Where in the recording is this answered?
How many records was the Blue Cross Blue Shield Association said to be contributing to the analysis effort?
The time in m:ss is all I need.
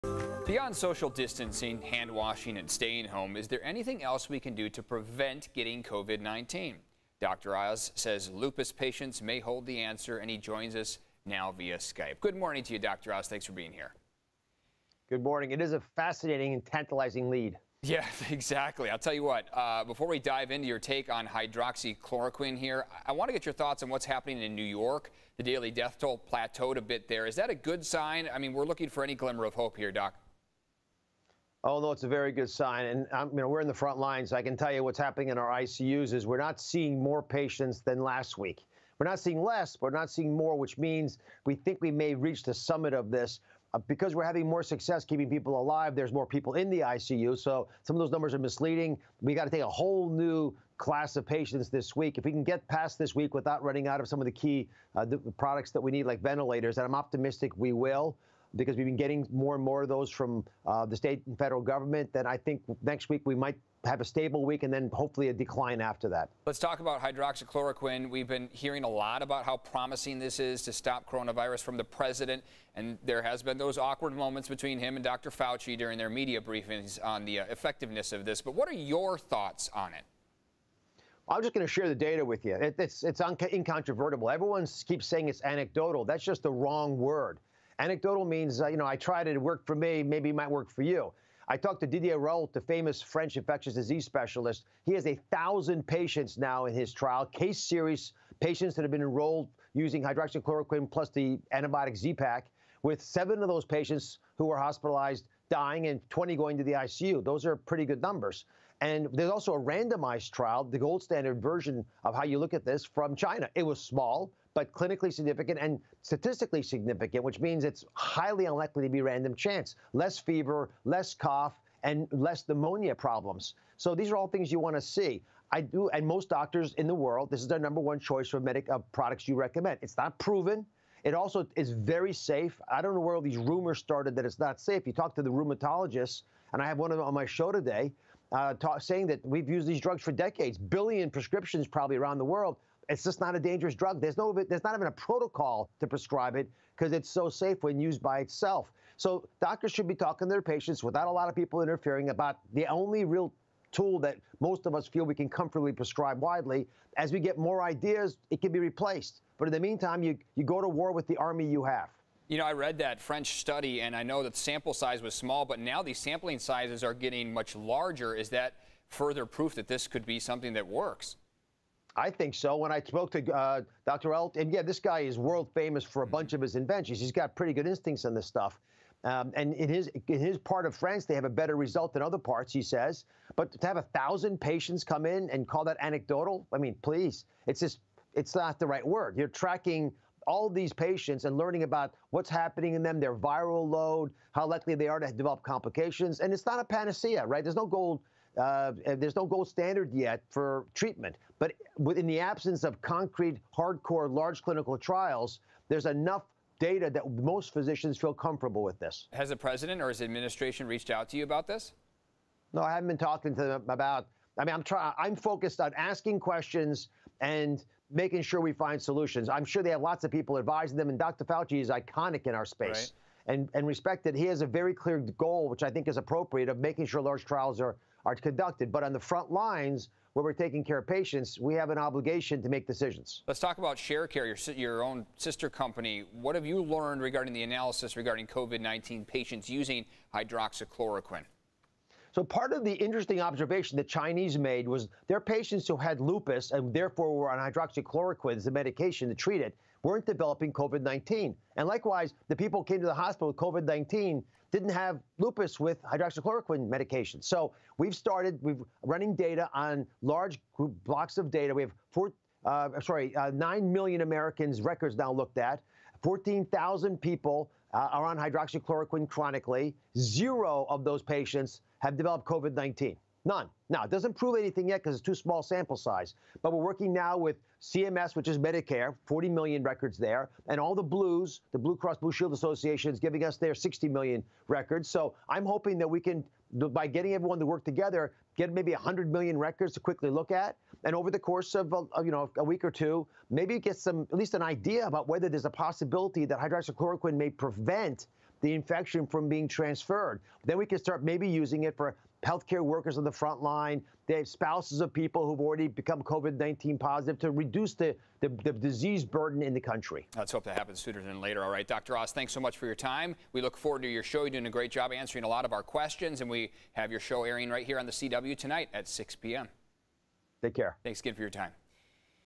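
4:43.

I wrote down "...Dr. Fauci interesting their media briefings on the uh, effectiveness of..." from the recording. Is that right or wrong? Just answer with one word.
wrong.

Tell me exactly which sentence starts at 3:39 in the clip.
I'm sure they have lots of people advising them, and Dr.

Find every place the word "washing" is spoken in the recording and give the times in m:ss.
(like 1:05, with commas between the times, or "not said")
0:02.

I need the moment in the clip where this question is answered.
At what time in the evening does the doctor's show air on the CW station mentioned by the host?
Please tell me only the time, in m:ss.
5:18.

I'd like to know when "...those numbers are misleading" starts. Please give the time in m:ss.
0:47.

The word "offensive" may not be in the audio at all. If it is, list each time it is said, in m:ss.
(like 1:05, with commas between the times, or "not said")
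not said.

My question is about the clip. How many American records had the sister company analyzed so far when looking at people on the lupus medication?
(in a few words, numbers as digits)
9 million.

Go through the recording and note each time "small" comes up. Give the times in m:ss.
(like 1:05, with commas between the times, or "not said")
1:53, 2:45, 4:35.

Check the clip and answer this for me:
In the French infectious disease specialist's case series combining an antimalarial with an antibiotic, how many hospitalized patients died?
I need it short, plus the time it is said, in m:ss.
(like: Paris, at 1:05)
7, at 1:43.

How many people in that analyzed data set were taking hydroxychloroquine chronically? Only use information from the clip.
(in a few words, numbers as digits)
14,000.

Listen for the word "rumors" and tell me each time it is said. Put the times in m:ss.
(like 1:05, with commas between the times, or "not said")
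2:13.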